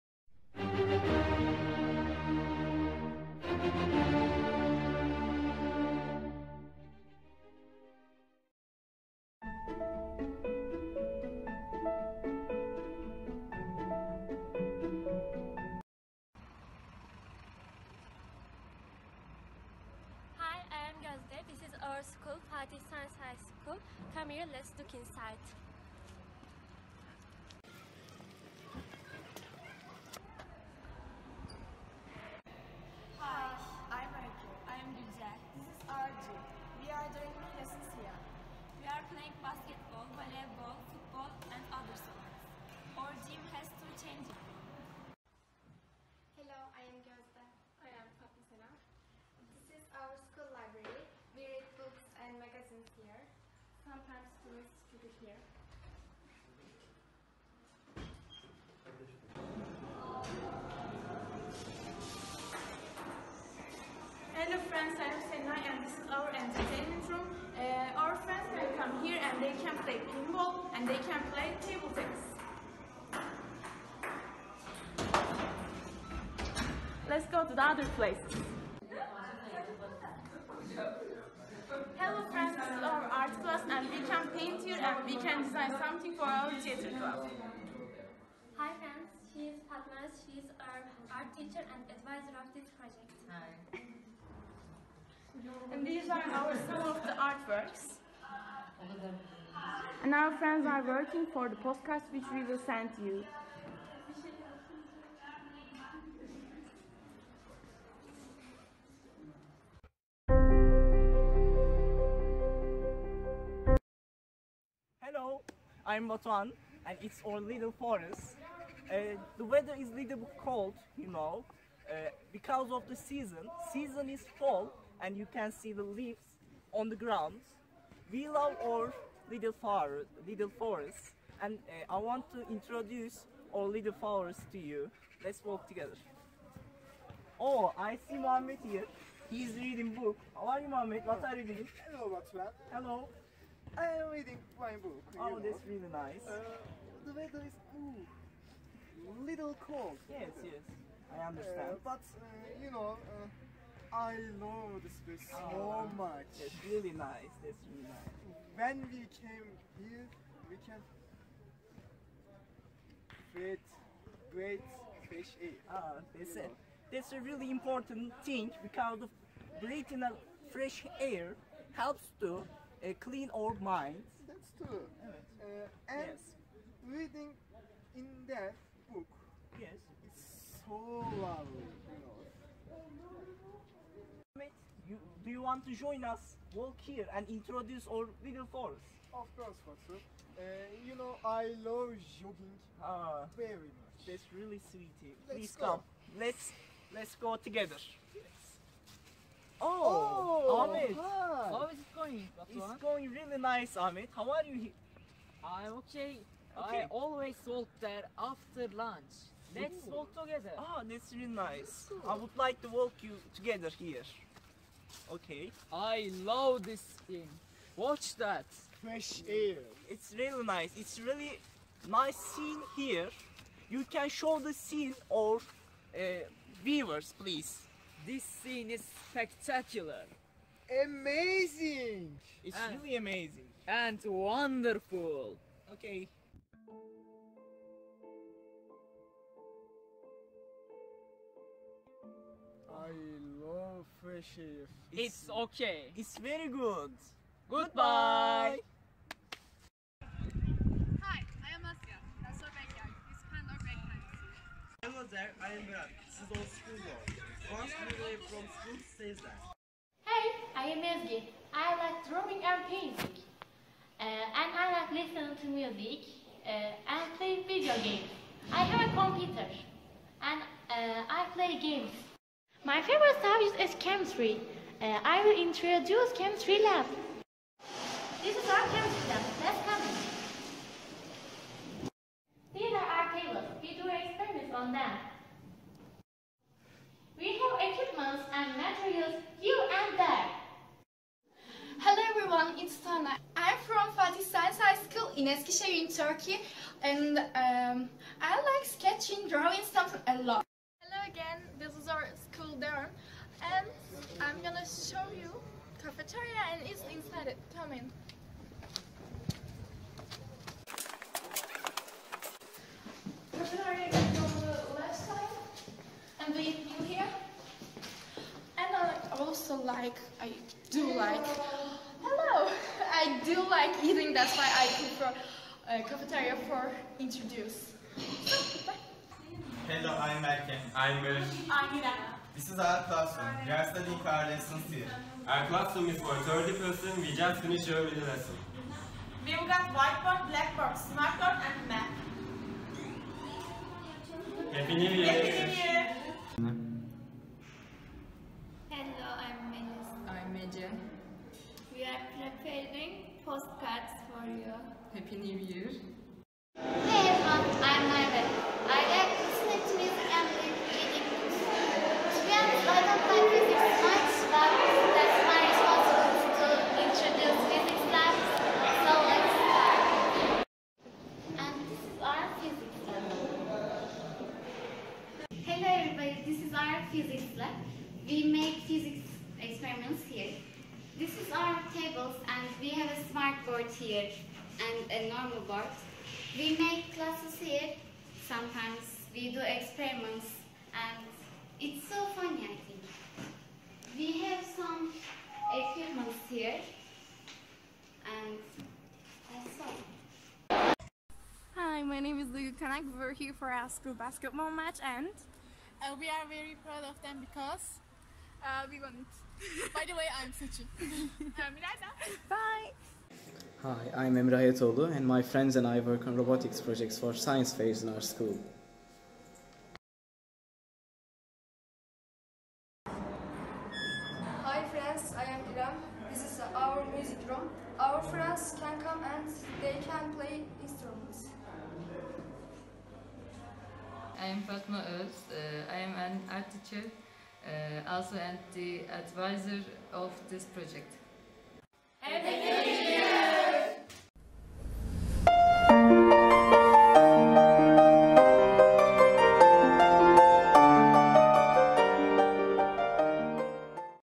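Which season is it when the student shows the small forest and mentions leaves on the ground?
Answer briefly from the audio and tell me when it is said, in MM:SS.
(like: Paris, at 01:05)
Fall, at 02:04.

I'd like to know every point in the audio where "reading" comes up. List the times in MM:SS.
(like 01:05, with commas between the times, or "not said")
02:19, 02:24, 02:56, 06:00.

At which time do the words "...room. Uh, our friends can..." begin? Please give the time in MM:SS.
01:07.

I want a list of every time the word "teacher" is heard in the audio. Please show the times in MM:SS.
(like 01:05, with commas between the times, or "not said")
01:31, 07:16.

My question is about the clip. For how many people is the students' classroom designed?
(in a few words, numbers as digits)
30.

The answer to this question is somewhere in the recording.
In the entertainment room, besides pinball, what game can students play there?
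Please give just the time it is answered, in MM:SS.
01:11.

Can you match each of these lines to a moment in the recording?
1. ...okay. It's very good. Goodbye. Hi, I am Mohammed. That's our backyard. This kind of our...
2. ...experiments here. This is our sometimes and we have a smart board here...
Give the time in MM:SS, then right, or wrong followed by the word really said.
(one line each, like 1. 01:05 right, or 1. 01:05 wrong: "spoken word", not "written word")
1. 04:05 wrong: "Asya", not "Mohammed"
2. 06:19 wrong: "tables", not "sometimes".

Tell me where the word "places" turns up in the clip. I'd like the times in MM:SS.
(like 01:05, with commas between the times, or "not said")
01:17, 02:35.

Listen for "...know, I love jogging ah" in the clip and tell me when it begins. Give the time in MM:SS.
03:10.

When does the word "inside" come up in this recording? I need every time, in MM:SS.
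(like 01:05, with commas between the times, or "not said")
00:24, 05:06.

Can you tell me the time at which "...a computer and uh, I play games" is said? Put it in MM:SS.
04:28.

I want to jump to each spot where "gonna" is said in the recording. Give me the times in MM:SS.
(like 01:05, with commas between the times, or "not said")
05:04.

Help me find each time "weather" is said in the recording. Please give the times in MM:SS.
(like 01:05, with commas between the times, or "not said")
01:59, 02:27.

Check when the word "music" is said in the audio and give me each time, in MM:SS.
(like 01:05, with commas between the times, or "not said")
04:25, 05:59, 07:06.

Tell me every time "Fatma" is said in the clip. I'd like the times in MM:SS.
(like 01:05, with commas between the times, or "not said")
01:29, 07:14.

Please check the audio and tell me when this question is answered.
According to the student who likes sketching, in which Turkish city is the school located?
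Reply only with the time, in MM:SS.
04:55.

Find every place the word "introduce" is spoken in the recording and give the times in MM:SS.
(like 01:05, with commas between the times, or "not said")
02:12, 03:07, 04:35, 05:26, 06:06.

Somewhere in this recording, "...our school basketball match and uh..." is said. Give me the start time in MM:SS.
06:43.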